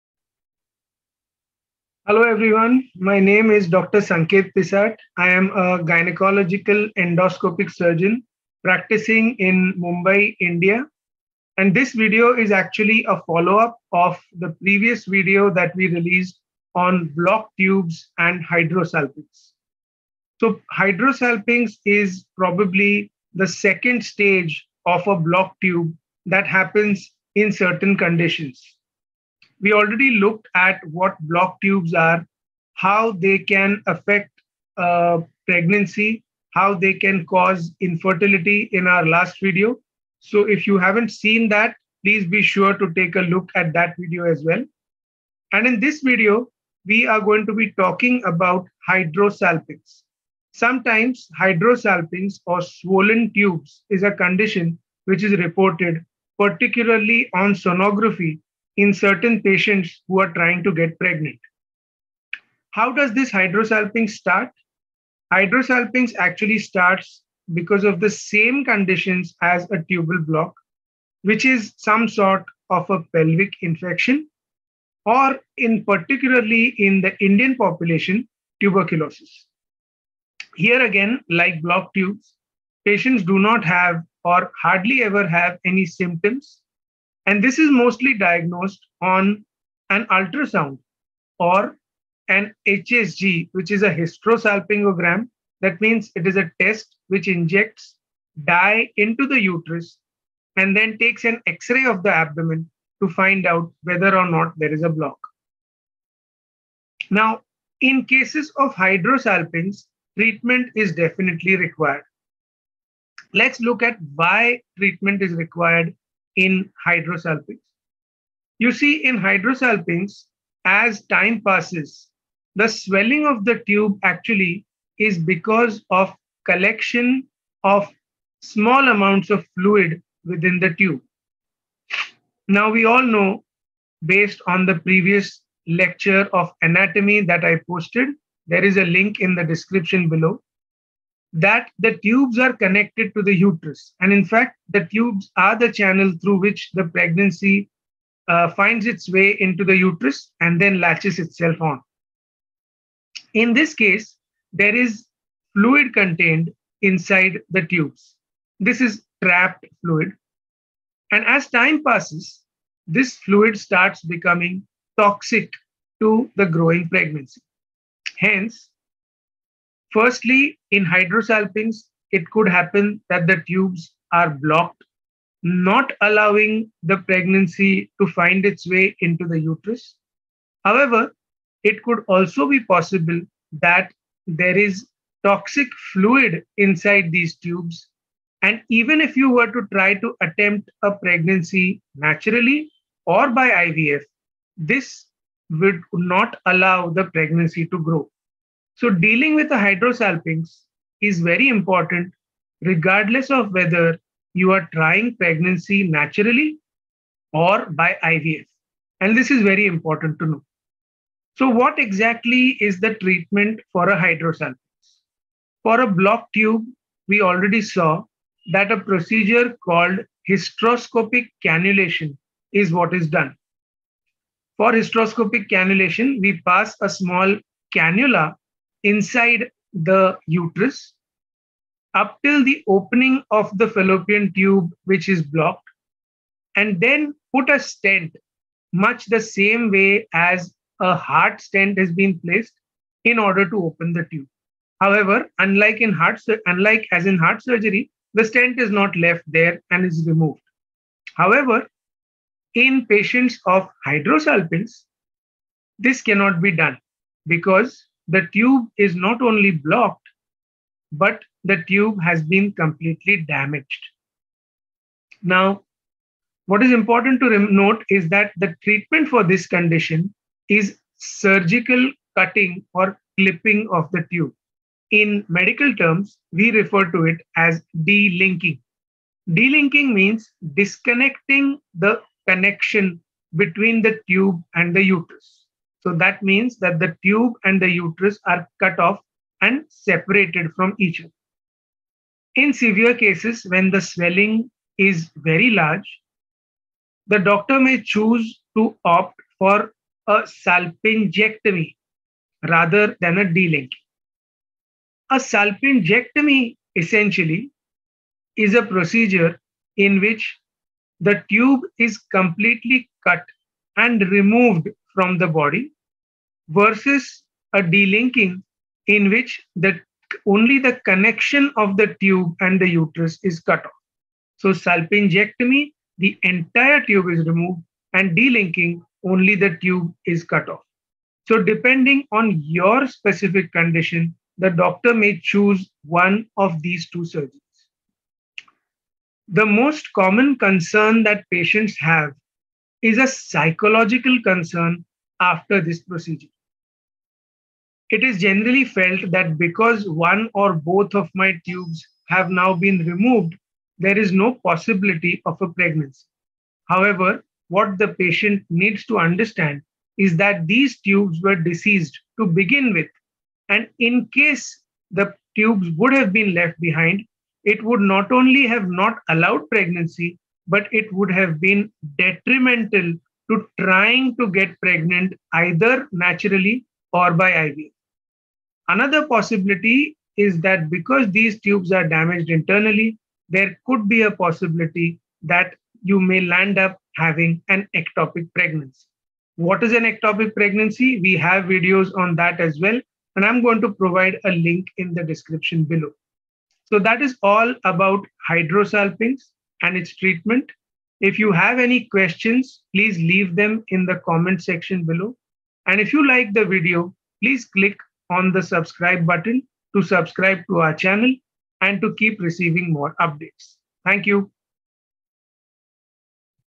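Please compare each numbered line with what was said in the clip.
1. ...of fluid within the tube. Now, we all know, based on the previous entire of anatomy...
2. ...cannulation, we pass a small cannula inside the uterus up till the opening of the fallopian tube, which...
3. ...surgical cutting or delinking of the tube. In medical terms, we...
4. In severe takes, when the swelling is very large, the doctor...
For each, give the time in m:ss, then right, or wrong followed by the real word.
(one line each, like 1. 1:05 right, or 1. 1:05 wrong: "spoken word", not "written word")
1. 2:09 wrong: "lecture", not "entire"
2. 3:45 right
3. 4:30 wrong: "clipping", not "delinking"
4. 4:52 wrong: "cases", not "takes".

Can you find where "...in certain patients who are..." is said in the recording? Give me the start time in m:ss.
0:58.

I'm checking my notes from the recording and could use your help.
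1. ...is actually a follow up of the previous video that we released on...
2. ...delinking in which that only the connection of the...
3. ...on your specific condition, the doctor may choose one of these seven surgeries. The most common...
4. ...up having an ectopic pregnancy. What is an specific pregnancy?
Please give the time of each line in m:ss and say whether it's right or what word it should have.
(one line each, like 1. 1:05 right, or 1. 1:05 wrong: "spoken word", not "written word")
1. 0:12 right
2. 5:17 right
3. 5:32 wrong: "two", not "seven"
4. 6:26 wrong: "ectopic", not "specific".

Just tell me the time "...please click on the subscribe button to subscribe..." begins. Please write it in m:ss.
6:47.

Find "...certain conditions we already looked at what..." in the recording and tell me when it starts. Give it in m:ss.
0:27.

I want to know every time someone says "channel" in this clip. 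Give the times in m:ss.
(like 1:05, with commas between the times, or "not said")
2:25, 6:50.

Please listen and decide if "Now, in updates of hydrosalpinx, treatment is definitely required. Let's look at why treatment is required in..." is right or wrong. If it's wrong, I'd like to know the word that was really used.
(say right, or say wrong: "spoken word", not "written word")
wrong: "cases", not "updates".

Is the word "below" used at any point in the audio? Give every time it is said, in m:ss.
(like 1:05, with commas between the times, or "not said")
2:20, 6:35, 6:44.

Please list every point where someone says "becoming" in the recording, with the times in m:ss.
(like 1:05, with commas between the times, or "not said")
2:44.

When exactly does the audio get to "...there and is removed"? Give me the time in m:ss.
4:09.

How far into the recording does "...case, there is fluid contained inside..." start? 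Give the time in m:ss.
2:33.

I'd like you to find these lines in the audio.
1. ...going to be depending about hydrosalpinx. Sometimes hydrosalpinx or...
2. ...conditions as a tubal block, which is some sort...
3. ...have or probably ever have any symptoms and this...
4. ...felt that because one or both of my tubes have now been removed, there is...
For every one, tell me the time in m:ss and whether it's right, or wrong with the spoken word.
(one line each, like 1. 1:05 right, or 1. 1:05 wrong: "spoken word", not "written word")
1. 0:47 wrong: "talking", not "depending"
2. 1:08 right
3. 1:23 wrong: "hardly", not "probably"
4. 5:48 right.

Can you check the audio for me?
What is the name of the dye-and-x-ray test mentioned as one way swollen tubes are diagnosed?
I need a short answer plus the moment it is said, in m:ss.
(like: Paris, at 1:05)
Hysterosalpingogram, at 1:33.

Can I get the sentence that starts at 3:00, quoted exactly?
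However, it could also be possible that there is toxic fluid inside these tubes.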